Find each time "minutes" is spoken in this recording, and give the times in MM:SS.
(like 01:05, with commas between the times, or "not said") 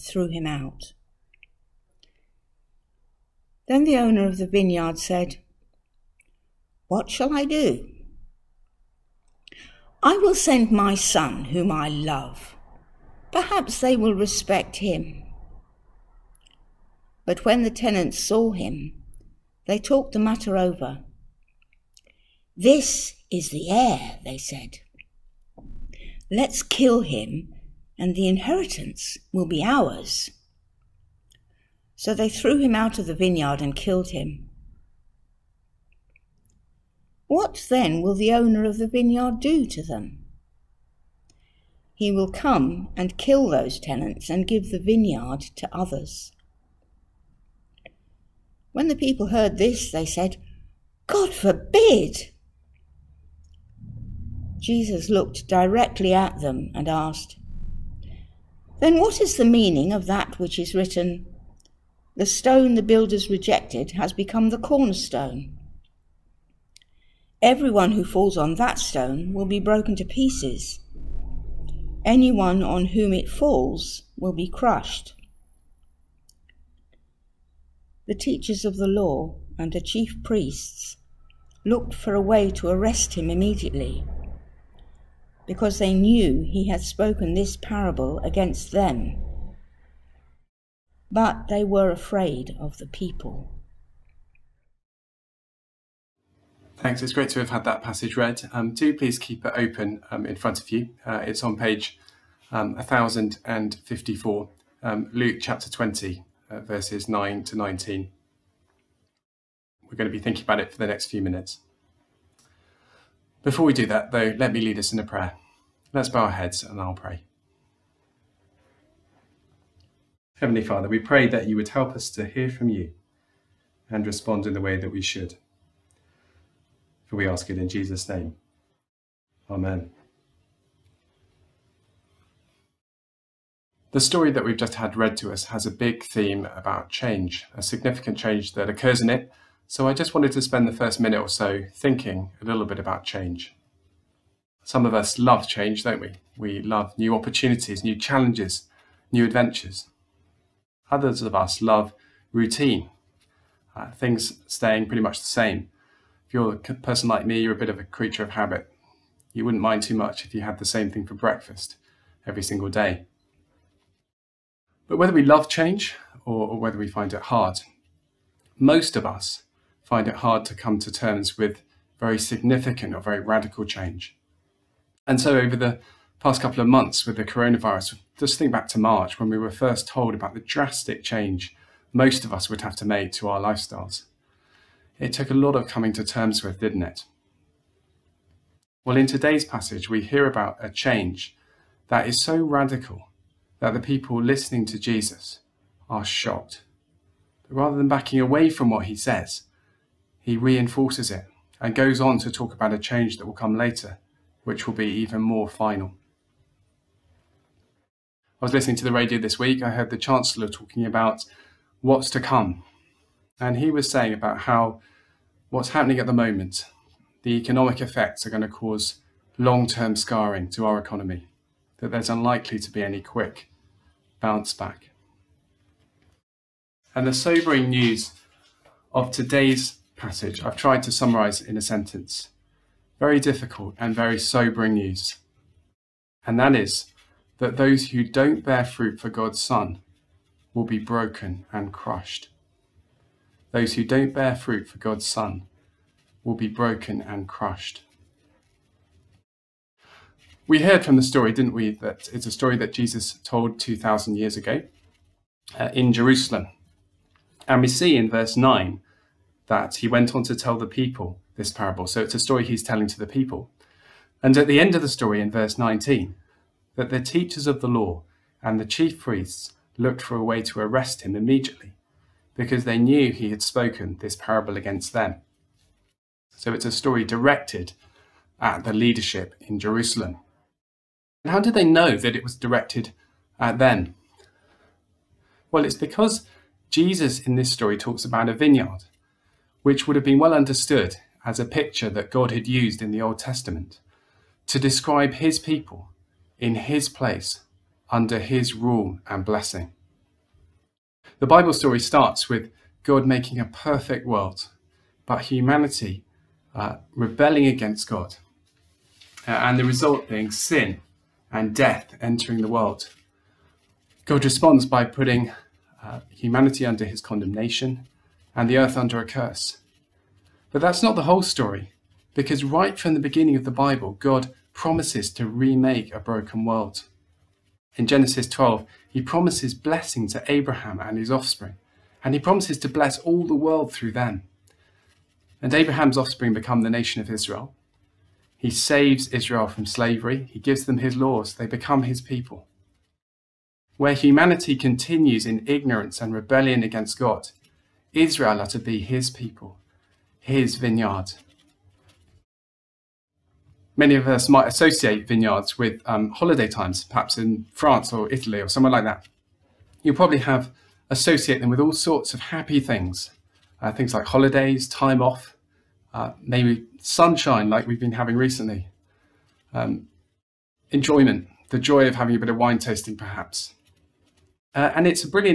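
01:51, 02:21.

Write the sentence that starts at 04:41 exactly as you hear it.
And how did they know that it was directed at them?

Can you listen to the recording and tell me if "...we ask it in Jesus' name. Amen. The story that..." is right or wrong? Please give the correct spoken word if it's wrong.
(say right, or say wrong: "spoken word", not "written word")
right.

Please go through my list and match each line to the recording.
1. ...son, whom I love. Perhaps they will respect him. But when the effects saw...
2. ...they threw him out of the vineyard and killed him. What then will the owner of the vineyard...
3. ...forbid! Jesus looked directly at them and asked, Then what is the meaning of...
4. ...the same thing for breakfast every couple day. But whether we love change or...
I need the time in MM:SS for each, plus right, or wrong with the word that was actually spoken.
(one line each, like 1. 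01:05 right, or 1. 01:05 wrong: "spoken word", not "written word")
1. 00:10 wrong: "tenants", not "effects"
2. 00:32 right
3. 00:51 right
4. 02:40 wrong: "single", not "couple".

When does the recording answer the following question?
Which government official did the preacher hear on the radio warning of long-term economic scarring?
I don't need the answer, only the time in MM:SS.
03:29.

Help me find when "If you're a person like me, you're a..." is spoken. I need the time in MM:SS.
02:36.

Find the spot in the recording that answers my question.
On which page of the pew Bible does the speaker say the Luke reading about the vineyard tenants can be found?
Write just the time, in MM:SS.
01:42.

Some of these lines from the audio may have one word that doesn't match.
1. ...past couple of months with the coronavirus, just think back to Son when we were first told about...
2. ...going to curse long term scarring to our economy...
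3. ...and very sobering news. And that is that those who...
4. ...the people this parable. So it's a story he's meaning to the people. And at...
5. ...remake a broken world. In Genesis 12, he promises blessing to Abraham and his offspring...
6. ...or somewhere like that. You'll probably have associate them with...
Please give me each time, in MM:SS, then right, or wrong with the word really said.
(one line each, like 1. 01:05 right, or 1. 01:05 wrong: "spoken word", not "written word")
1. 02:56 wrong: "March", not "Son"
2. 03:38 wrong: "cause", not "curse"
3. 03:53 right
4. 04:20 wrong: "telling", not "meaning"
5. 05:25 right
6. 05:58 right.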